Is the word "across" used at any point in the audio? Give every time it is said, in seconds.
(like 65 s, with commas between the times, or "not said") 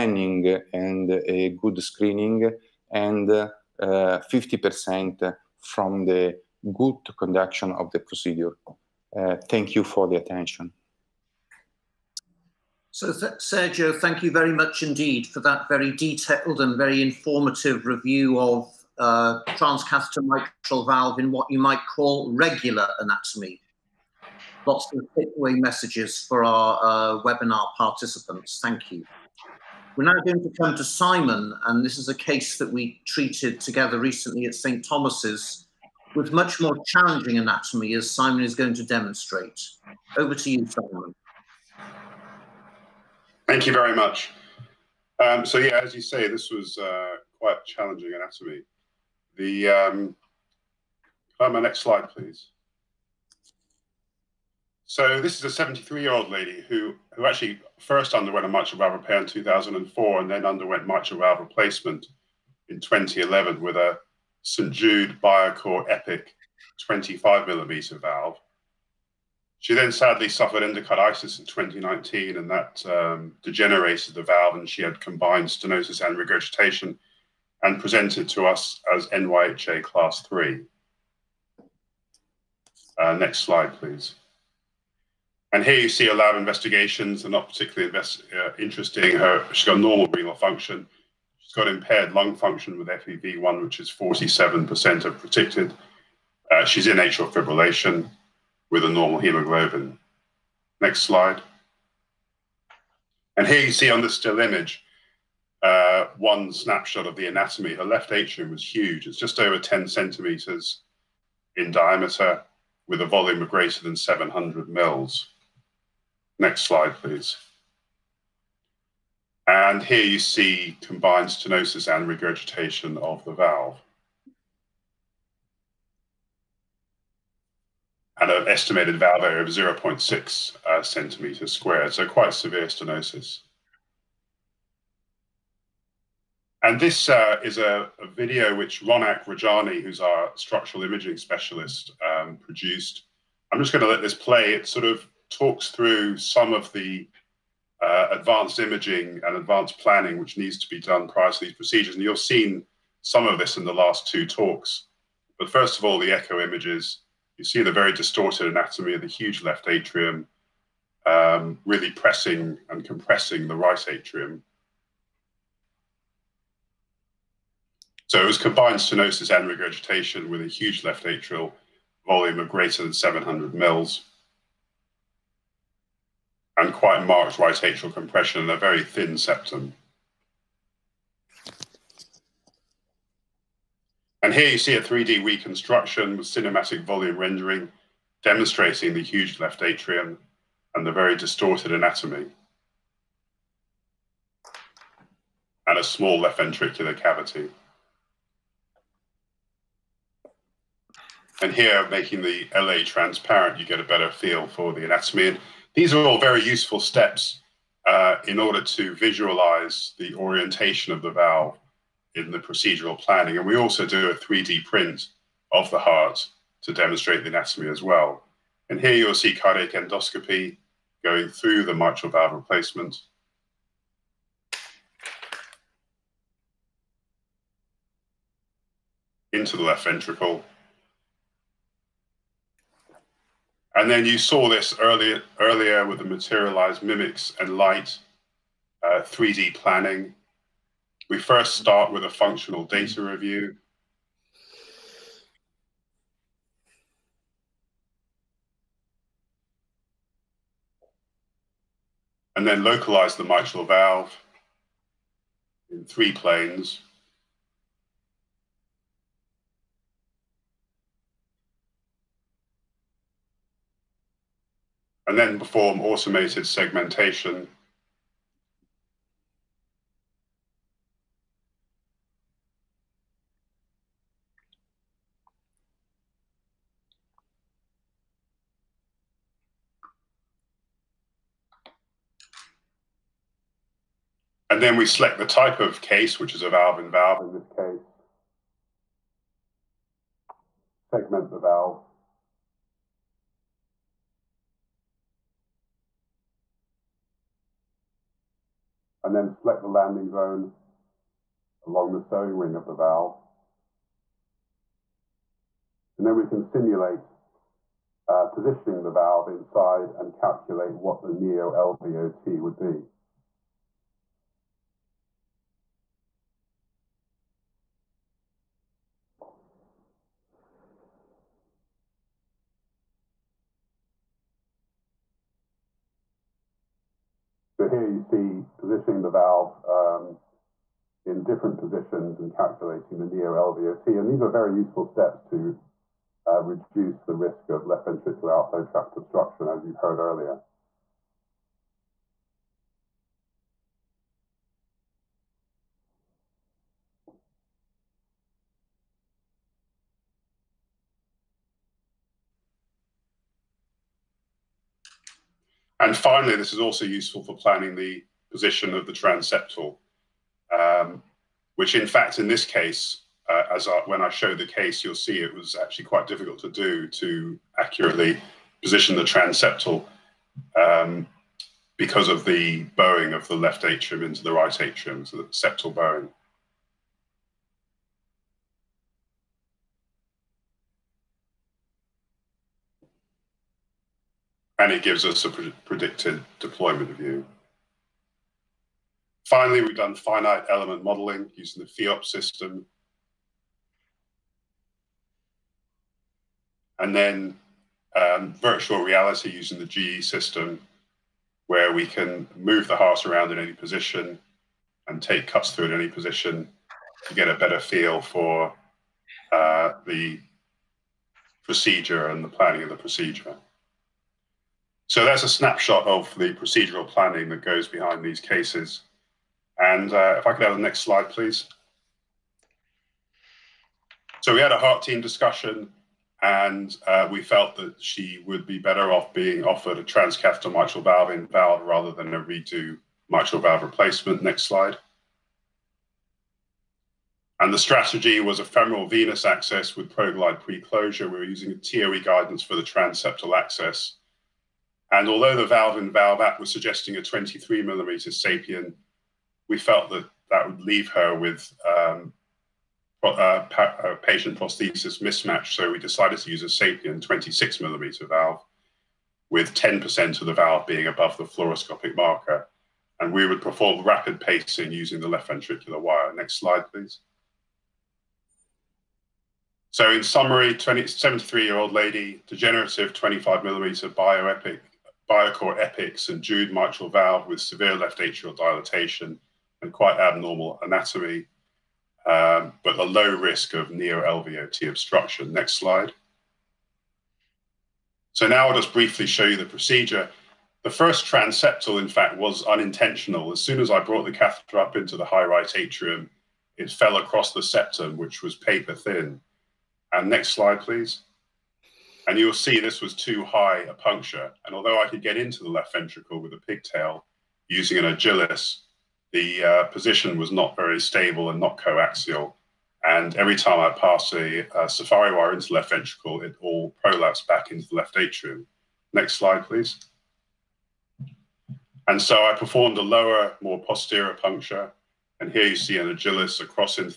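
496 s, 526 s.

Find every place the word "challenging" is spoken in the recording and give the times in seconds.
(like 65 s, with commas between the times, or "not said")
36 s, 47 s.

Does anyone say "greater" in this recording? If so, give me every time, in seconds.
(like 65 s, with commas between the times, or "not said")
113 s, 172 s.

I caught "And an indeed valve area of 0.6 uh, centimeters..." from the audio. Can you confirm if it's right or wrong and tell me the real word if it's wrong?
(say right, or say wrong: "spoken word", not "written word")
wrong: "estimated", not "indeed".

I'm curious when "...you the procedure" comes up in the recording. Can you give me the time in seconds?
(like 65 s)
489 s.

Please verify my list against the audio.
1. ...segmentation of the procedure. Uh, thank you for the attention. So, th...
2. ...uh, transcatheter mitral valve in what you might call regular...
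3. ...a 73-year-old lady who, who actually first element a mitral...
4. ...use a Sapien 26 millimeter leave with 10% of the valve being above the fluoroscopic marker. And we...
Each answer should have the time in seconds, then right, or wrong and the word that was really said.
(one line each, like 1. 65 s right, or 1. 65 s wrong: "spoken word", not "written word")
1. 7 s wrong: "conduction", not "segmentation"
2. 18 s right
3. 55 s wrong: "underwent", not "element"
4. 456 s wrong: "valve", not "leave".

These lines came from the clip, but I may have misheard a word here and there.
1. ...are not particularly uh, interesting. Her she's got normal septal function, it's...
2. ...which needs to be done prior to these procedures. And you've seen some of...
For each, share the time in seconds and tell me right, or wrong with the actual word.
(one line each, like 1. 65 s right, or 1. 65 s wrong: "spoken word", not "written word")
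1. 87 s wrong: "renal", not "septal"
2. 150 s right.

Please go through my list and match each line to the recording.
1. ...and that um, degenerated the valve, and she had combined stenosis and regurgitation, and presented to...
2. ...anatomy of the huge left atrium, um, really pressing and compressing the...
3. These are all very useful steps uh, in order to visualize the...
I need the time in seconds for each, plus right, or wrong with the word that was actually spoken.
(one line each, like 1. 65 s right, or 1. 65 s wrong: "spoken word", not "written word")
1. 72 s right
2. 158 s right
3. 205 s right.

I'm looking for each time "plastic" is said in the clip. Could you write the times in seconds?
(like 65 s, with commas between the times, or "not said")
not said.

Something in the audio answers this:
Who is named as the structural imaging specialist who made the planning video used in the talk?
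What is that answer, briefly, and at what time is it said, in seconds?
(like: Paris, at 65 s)
Ronak Rajani, at 138 s.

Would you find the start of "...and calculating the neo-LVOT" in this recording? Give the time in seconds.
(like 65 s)
332 s.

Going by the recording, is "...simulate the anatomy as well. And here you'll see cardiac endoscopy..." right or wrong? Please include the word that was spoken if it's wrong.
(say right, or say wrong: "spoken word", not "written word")
wrong: "demonstrate", not "simulate".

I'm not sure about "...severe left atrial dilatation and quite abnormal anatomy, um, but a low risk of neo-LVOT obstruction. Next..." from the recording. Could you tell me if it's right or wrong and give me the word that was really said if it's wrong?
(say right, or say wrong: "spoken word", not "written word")
right.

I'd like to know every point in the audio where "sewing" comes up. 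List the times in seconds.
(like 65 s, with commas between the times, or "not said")
301 s.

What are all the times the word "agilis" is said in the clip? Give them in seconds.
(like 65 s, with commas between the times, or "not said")
507 s, 525 s.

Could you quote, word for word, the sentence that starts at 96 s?
Uh, she's in atrial fibrillation with a normal hemoglobin.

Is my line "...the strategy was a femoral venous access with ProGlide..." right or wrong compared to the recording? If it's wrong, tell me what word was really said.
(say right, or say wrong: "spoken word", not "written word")
right.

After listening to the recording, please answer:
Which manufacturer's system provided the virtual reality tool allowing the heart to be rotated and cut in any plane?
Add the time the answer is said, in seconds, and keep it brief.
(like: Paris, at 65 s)
GE, at 399 s.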